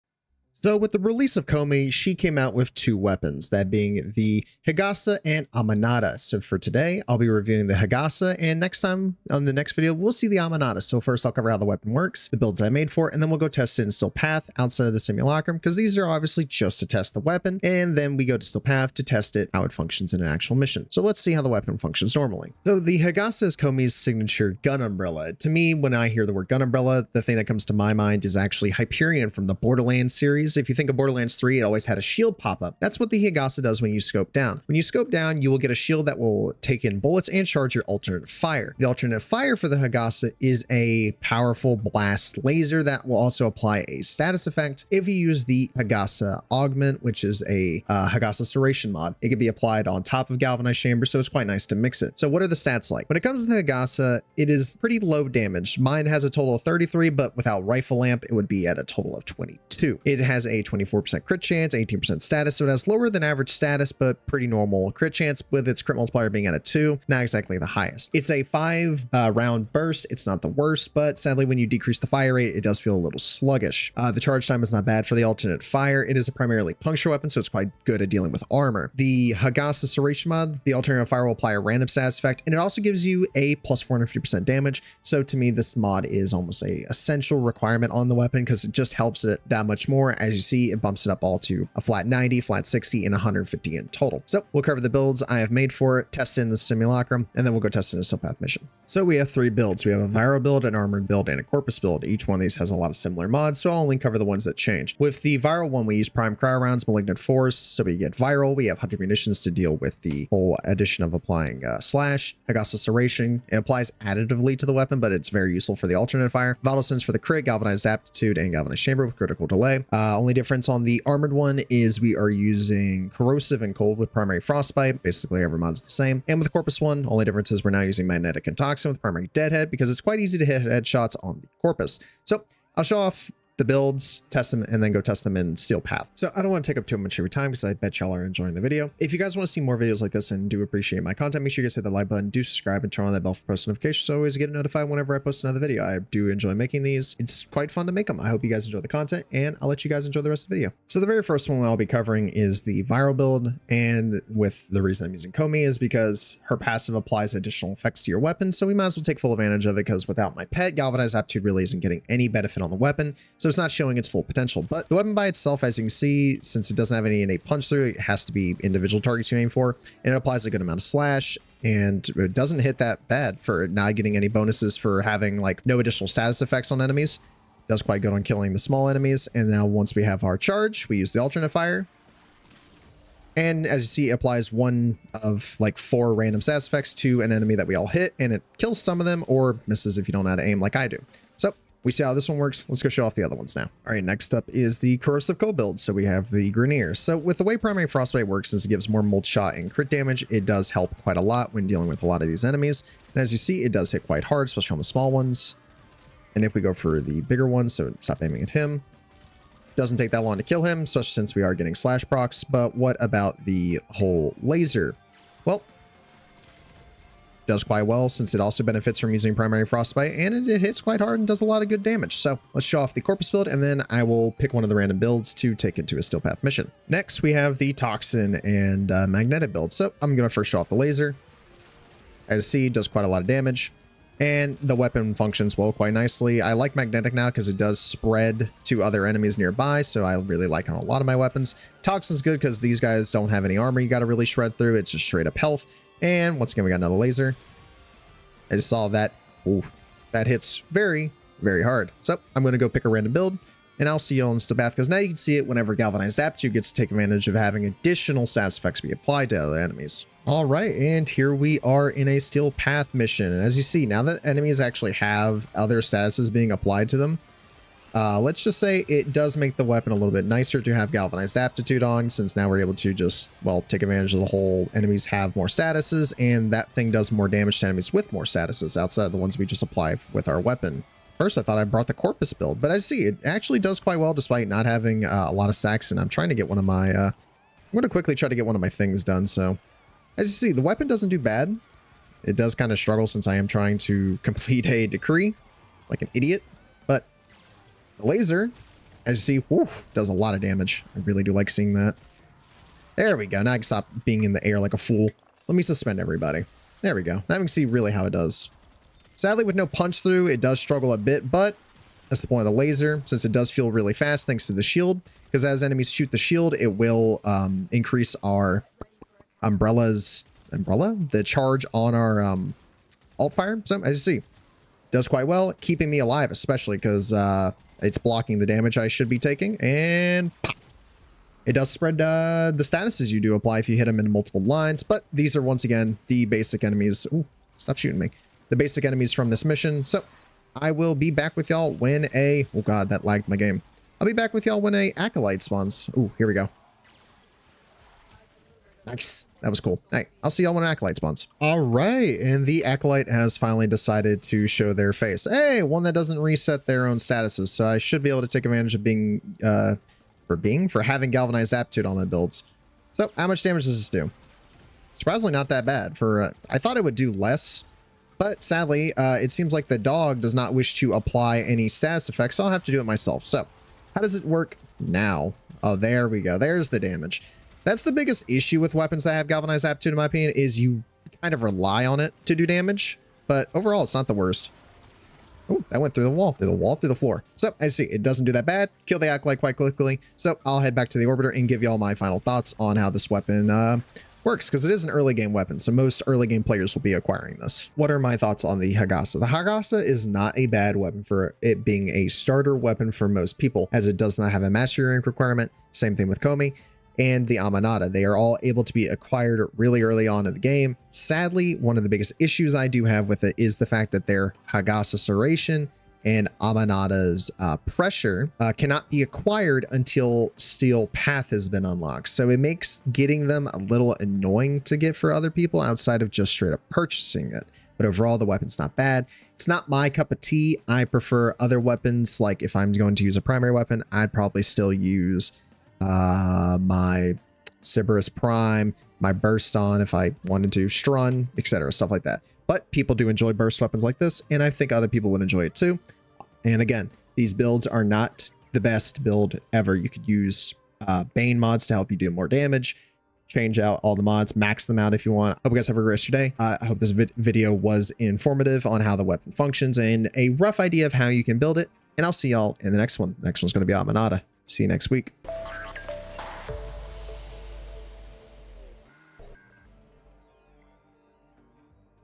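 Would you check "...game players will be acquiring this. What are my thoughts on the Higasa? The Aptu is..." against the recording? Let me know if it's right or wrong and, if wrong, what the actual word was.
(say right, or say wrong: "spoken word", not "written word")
wrong: "Higasa", not "Aptu".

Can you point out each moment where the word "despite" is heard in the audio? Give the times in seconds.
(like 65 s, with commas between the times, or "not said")
284 s.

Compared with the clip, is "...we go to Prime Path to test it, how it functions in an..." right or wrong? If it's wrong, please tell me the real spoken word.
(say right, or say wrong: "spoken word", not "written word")
wrong: "Steel", not "Prime".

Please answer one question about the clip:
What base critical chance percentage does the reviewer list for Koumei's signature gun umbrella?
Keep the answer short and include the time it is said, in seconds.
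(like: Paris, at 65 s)
24%, at 60 s.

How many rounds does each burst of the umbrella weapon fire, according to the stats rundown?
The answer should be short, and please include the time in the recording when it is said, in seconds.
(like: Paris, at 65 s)
5, at 68 s.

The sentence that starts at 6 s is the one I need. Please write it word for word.
So, for today, I'll be reviewing the Higasa, and next time on the next video, we'll see the Amanata.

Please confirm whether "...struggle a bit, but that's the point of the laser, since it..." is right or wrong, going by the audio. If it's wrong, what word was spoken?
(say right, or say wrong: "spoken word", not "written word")
right.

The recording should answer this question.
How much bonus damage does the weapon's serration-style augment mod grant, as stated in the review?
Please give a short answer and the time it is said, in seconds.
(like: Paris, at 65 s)
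450%, at 83 s.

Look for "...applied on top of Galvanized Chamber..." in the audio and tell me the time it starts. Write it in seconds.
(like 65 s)
49 s.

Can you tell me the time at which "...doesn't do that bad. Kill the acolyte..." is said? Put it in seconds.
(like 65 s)
388 s.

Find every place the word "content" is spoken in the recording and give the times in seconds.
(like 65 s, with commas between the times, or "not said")
141 s, 148 s.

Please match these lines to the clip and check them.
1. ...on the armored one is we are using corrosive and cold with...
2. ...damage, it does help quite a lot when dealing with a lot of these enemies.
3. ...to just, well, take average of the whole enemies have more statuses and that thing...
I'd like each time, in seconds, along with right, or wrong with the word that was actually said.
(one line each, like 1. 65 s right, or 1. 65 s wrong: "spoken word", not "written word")
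1. 120 s right
2. 199 s right
3. 272 s wrong: "advantage", not "average".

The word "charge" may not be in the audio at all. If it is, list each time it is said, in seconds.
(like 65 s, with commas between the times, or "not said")
37 s, 74 s, 180 s, 321 s.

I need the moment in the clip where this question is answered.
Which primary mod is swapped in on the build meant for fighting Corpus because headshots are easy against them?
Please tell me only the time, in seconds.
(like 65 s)
129 s.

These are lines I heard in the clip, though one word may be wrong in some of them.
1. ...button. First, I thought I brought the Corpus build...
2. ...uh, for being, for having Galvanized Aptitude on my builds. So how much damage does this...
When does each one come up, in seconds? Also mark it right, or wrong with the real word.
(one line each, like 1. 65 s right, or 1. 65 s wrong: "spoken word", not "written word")
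1. 280 s wrong: "weapon", not "button"
2. 359 s right.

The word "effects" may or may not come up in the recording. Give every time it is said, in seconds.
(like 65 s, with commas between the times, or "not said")
44 s, 82 s, 157 s, 176 s, 186 s, 258 s, 372 s.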